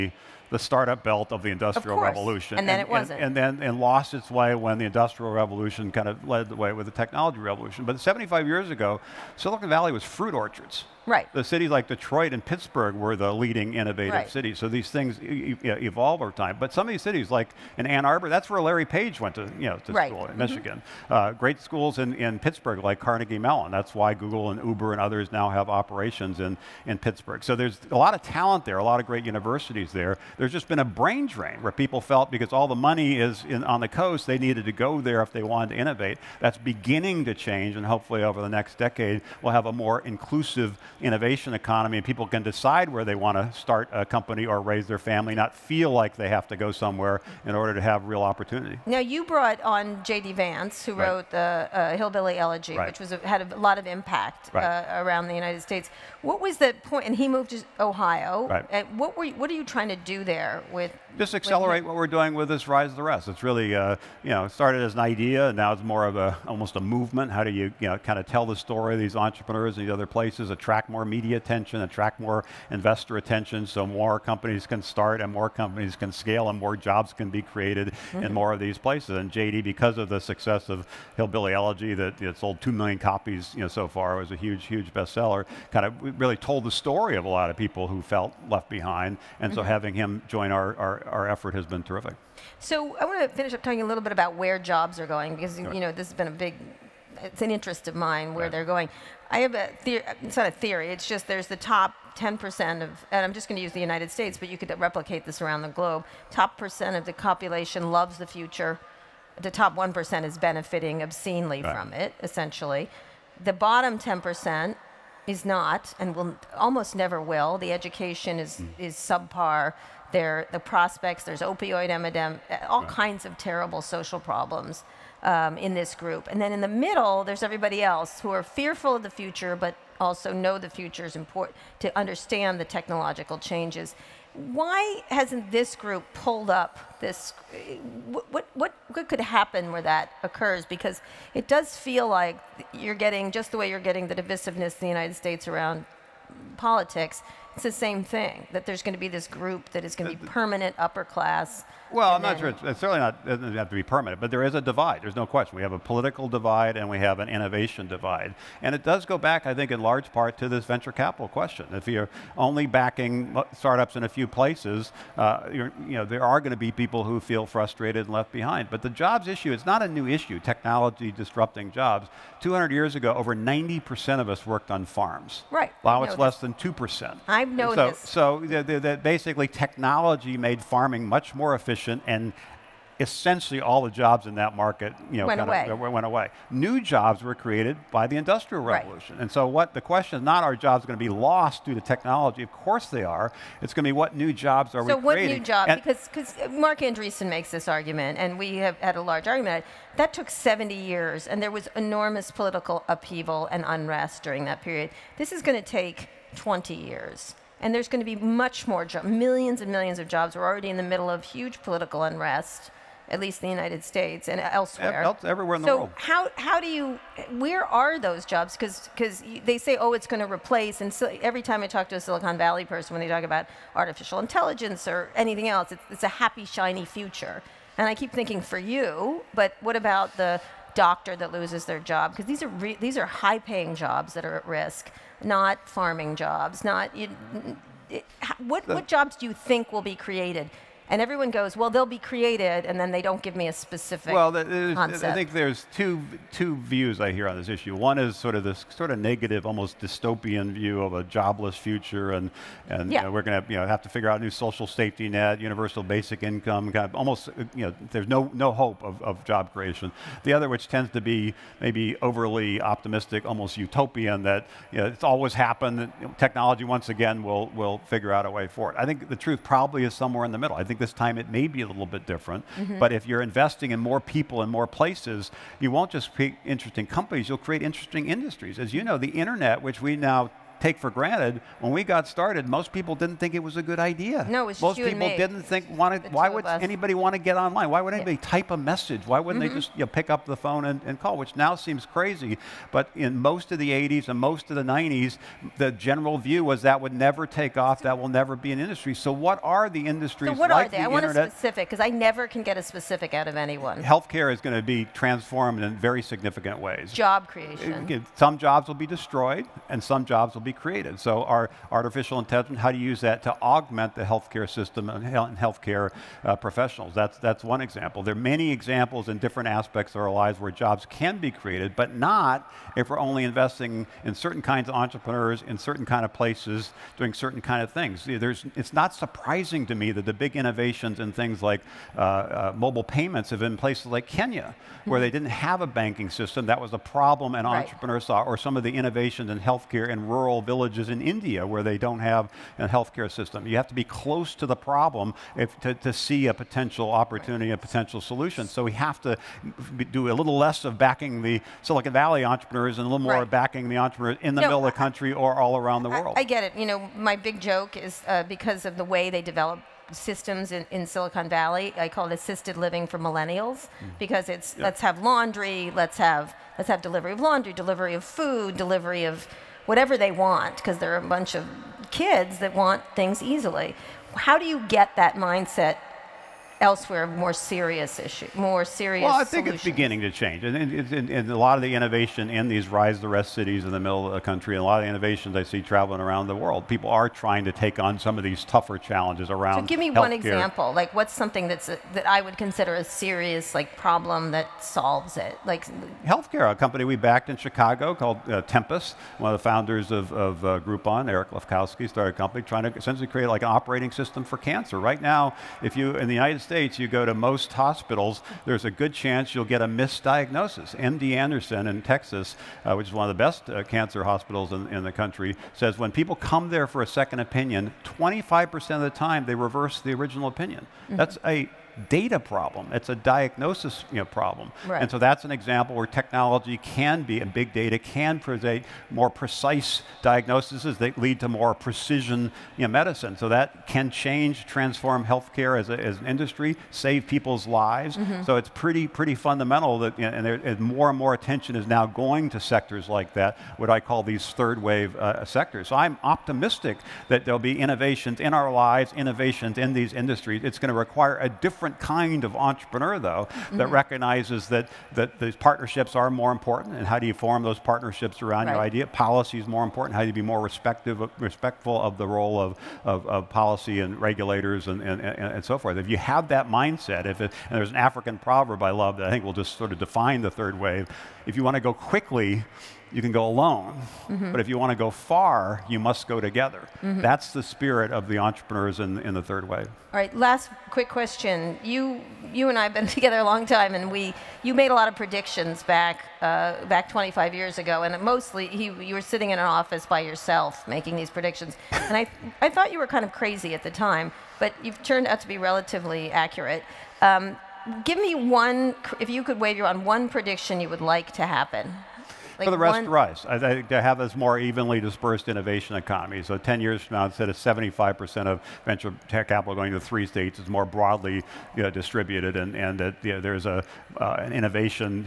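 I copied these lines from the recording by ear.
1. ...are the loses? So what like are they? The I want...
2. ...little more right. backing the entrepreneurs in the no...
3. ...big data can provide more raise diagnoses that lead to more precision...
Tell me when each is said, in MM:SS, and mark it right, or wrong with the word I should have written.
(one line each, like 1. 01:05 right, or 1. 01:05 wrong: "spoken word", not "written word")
1. 04:59 wrong: "industries", not "loses"
2. 05:52 right
3. 07:07 wrong: "precise", not "raise".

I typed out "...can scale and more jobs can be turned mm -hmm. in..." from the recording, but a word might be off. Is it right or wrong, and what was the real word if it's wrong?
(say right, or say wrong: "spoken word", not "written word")
wrong: "created", not "turned".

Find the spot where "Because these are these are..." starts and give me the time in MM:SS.
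03:52.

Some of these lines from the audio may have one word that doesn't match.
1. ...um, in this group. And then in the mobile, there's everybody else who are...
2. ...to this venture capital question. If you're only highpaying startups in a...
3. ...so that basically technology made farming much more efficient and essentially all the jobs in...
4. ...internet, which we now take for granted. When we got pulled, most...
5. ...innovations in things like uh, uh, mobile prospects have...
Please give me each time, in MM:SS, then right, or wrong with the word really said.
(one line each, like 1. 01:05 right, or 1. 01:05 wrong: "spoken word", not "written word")
1. 02:05 wrong: "middle", not "mobile"
2. 02:40 wrong: "backing", not "highpaying"
3. 02:58 right
4. 04:39 wrong: "started", not "pulled"
5. 05:30 wrong: "payments", not "prospects".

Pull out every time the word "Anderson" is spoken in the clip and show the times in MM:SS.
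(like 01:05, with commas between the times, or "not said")
06:51.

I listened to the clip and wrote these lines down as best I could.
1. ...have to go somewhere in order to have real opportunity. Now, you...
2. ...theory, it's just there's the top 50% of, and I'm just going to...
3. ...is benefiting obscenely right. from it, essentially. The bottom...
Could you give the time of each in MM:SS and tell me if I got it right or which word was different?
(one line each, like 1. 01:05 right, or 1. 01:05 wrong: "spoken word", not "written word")
1. 00:46 right
2. 01:40 wrong: "10", not "50"
3. 01:50 right.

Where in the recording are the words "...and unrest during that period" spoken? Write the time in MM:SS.
03:23.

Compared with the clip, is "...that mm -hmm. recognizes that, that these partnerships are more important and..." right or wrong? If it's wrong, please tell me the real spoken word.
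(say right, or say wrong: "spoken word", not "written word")
right.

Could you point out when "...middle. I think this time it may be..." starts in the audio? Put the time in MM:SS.
04:30.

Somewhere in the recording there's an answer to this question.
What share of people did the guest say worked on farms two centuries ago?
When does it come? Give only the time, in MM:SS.
02:53.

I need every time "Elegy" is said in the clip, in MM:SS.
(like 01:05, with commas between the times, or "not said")
00:52, 01:21.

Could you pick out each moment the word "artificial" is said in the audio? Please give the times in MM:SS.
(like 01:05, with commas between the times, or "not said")
03:43, 05:11.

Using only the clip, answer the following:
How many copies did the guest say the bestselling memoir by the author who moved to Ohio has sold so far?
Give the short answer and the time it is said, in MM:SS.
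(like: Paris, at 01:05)
2 million, at 01:22.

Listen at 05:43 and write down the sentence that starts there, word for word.
You have to be close to the problem if, to, to see a potential opportunity, a potential solution.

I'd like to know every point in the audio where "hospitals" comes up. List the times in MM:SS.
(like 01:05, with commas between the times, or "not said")
06:47, 06:54.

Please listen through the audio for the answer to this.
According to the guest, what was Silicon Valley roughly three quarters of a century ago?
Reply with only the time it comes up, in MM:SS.
00:10.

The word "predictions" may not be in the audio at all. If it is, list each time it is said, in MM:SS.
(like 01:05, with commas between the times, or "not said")
08:04, 08:11, 08:20.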